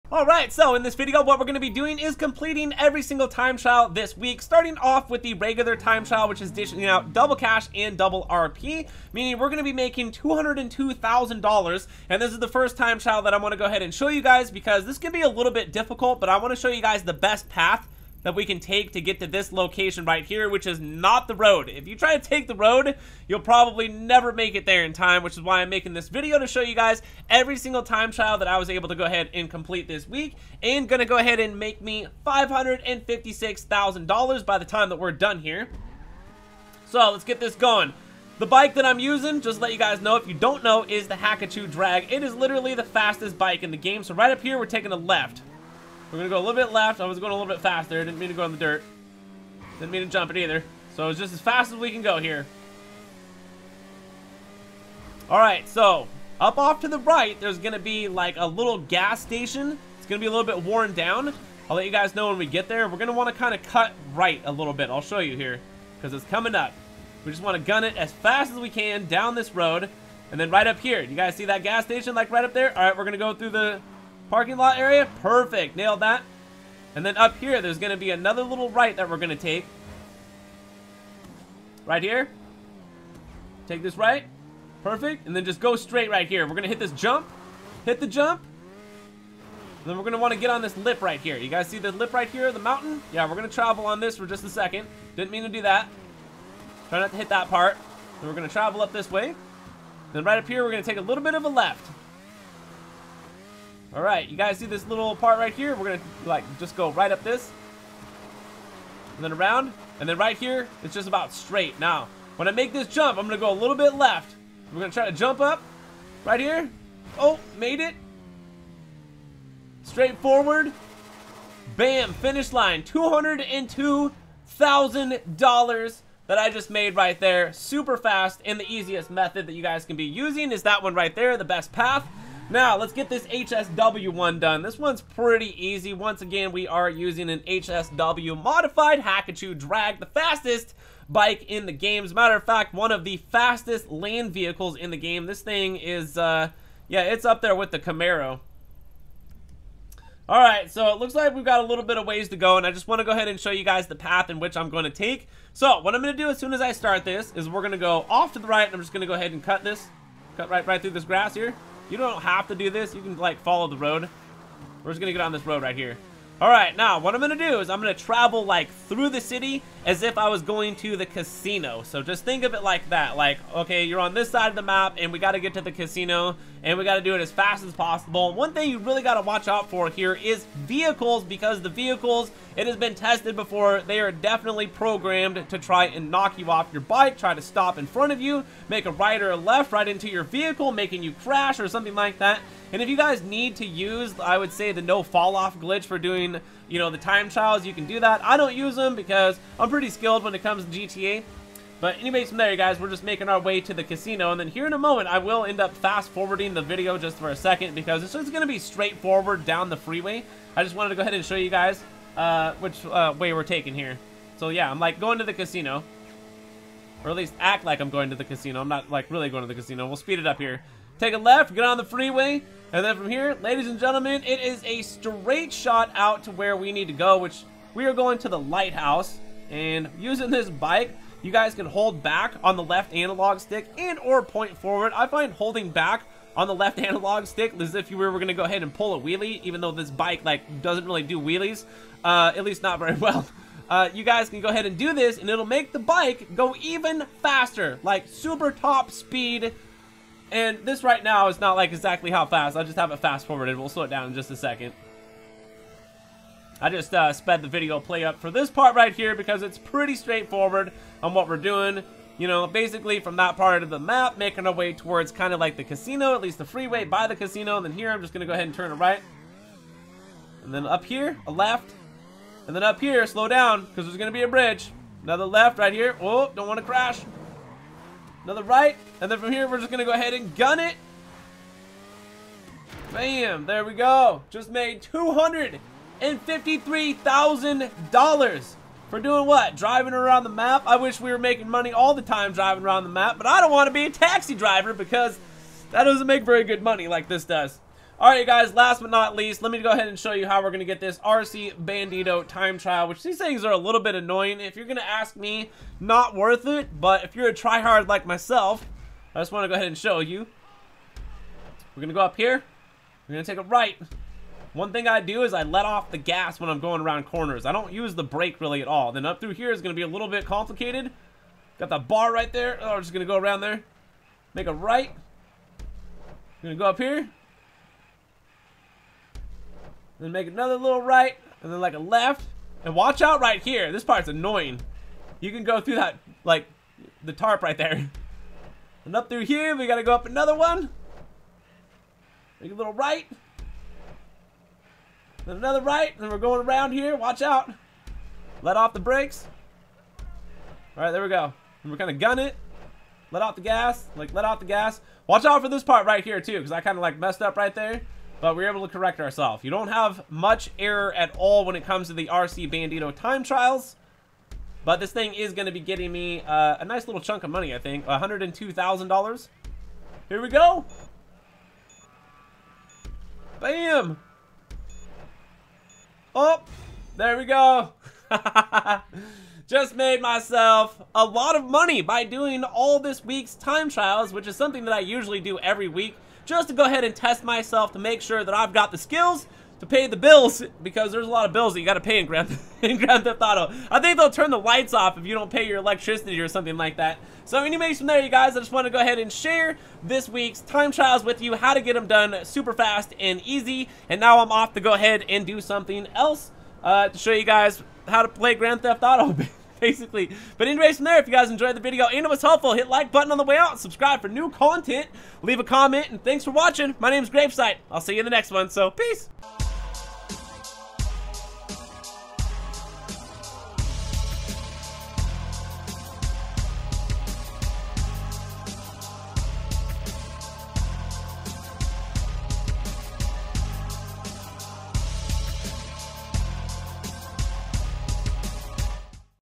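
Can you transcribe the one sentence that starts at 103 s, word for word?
All right, you guys see this little part right here?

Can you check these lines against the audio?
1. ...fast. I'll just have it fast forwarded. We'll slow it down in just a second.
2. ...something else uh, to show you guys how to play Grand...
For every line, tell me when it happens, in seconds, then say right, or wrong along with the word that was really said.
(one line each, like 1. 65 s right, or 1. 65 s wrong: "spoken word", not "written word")
1. 252 s right
2. 405 s right.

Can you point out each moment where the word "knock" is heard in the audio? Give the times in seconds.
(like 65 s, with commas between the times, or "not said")
186 s.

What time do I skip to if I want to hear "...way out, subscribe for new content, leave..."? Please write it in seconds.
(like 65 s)
413 s.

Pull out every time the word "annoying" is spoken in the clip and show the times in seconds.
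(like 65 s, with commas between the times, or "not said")
303 s, 334 s.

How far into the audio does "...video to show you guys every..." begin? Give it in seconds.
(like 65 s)
26 s.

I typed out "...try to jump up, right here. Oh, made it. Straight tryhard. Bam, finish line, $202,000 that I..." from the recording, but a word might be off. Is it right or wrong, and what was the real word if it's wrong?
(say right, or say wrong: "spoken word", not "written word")
wrong: "forward", not "tryhard".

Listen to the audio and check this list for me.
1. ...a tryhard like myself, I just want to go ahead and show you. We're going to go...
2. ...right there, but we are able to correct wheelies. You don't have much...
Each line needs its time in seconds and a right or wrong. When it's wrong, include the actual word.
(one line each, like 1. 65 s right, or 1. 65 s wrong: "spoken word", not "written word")
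1. 307 s right
2. 357 s wrong: "ourselves", not "wheelies".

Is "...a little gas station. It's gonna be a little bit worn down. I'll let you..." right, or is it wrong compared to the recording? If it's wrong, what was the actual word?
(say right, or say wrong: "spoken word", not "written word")
right.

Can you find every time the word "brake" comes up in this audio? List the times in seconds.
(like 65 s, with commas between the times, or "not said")
318 s, 348 s.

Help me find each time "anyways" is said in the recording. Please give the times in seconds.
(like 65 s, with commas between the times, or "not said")
201 s, 397 s, 410 s.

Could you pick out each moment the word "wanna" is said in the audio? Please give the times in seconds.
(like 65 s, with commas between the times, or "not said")
63 s, 67 s.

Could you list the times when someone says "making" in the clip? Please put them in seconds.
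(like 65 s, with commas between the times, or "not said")
9 s, 25 s, 190 s, 203 s, 264 s, 291 s.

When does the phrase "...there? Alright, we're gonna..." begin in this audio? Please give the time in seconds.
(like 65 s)
72 s.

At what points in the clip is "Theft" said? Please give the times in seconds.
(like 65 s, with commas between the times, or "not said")
393 s, 408 s.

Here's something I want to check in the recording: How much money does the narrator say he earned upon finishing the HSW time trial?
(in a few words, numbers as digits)
$153,000.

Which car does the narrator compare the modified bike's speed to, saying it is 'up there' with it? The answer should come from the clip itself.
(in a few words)
Camaro.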